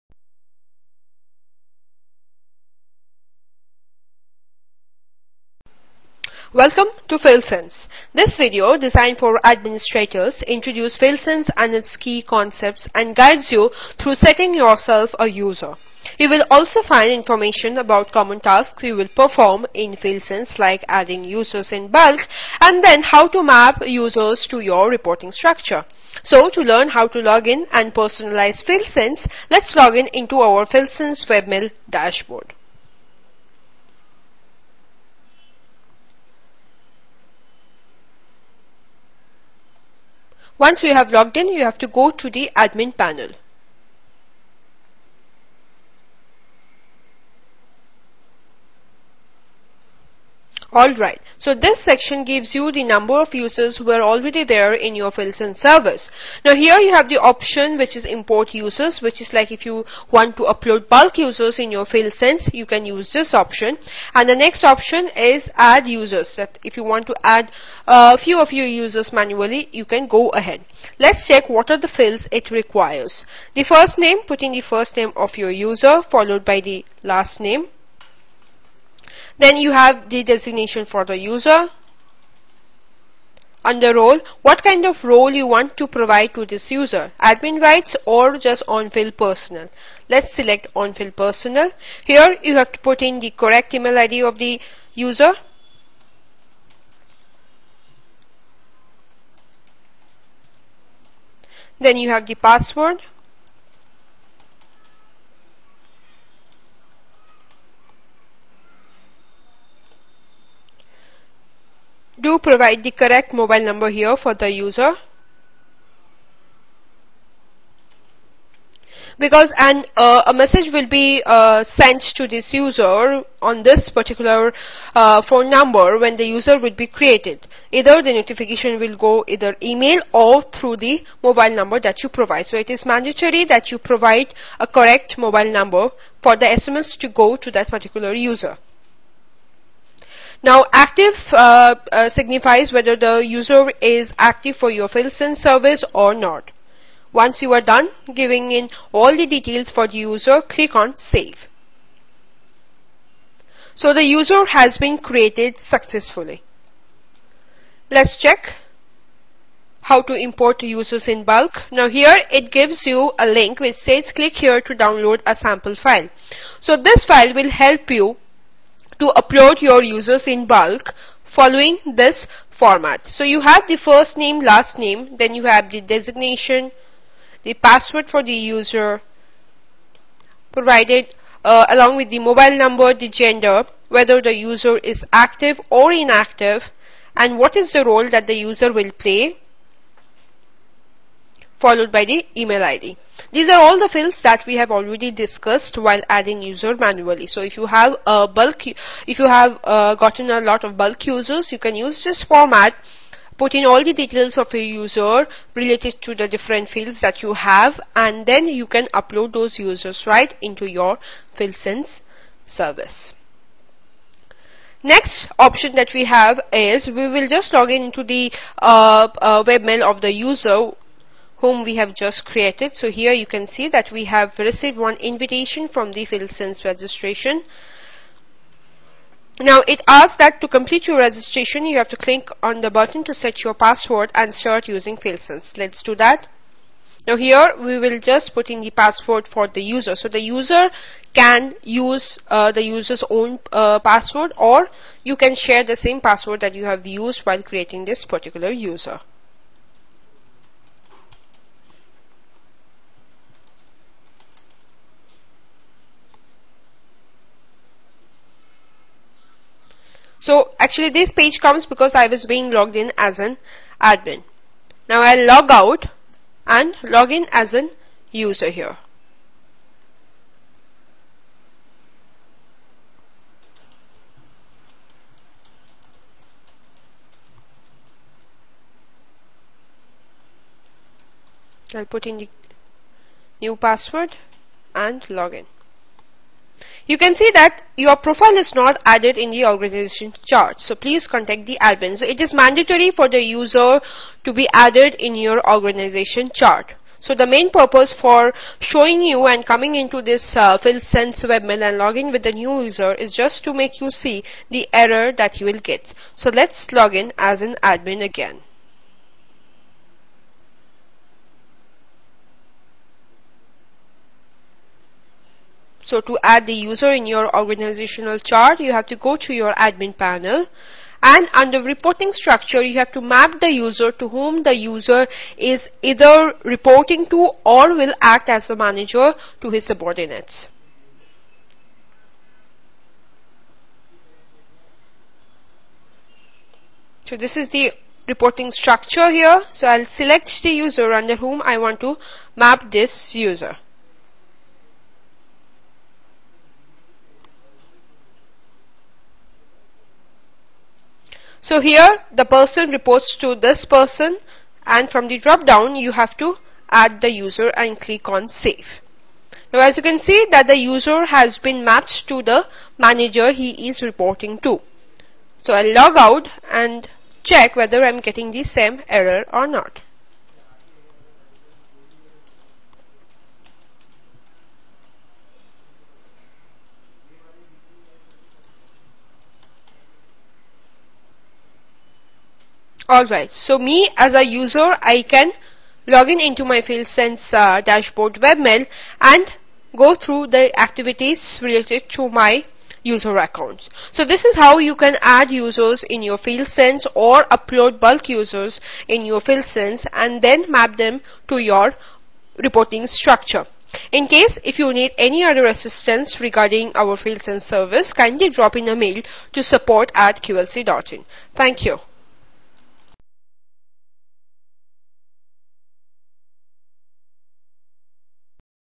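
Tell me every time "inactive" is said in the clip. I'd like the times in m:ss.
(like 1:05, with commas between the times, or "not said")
3:05.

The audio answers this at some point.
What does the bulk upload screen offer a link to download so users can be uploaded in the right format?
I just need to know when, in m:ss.
2:45.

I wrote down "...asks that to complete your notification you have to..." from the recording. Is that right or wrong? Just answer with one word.
wrong.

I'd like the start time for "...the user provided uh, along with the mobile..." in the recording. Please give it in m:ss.
2:58.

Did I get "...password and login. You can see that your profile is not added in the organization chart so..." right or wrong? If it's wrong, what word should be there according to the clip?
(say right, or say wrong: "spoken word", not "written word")
right.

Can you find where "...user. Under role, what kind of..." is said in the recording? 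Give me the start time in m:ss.
1:21.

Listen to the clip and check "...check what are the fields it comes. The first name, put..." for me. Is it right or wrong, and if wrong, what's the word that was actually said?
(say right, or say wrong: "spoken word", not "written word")
wrong: "requires", not "comes".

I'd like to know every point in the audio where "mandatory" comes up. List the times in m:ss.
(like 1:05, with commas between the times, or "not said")
2:12, 4:52.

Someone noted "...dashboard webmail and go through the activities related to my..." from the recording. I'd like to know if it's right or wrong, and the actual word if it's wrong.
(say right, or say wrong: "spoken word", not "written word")
right.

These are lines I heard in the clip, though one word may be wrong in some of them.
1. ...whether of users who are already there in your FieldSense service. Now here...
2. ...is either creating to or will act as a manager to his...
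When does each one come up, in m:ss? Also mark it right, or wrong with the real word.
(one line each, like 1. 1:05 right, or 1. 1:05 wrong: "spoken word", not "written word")
1. 0:52 wrong: "number", not "whether"
2. 5:25 wrong: "reporting", not "creating".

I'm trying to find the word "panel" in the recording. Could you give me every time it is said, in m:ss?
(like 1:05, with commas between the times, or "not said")
0:42, 5:19.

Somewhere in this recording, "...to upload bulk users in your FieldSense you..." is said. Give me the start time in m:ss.
1:00.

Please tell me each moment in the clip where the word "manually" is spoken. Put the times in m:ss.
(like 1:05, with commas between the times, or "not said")
1:09, 3:16.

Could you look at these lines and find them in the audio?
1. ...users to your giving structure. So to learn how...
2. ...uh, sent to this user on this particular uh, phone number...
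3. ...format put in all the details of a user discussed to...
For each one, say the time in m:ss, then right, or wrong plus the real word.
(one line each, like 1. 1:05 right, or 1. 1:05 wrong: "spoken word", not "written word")
1. 0:23 wrong: "reporting", not "giving"
2. 2:01 right
3. 3:22 wrong: "related", not "discussed".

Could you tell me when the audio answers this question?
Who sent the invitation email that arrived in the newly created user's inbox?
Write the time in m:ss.
3:46.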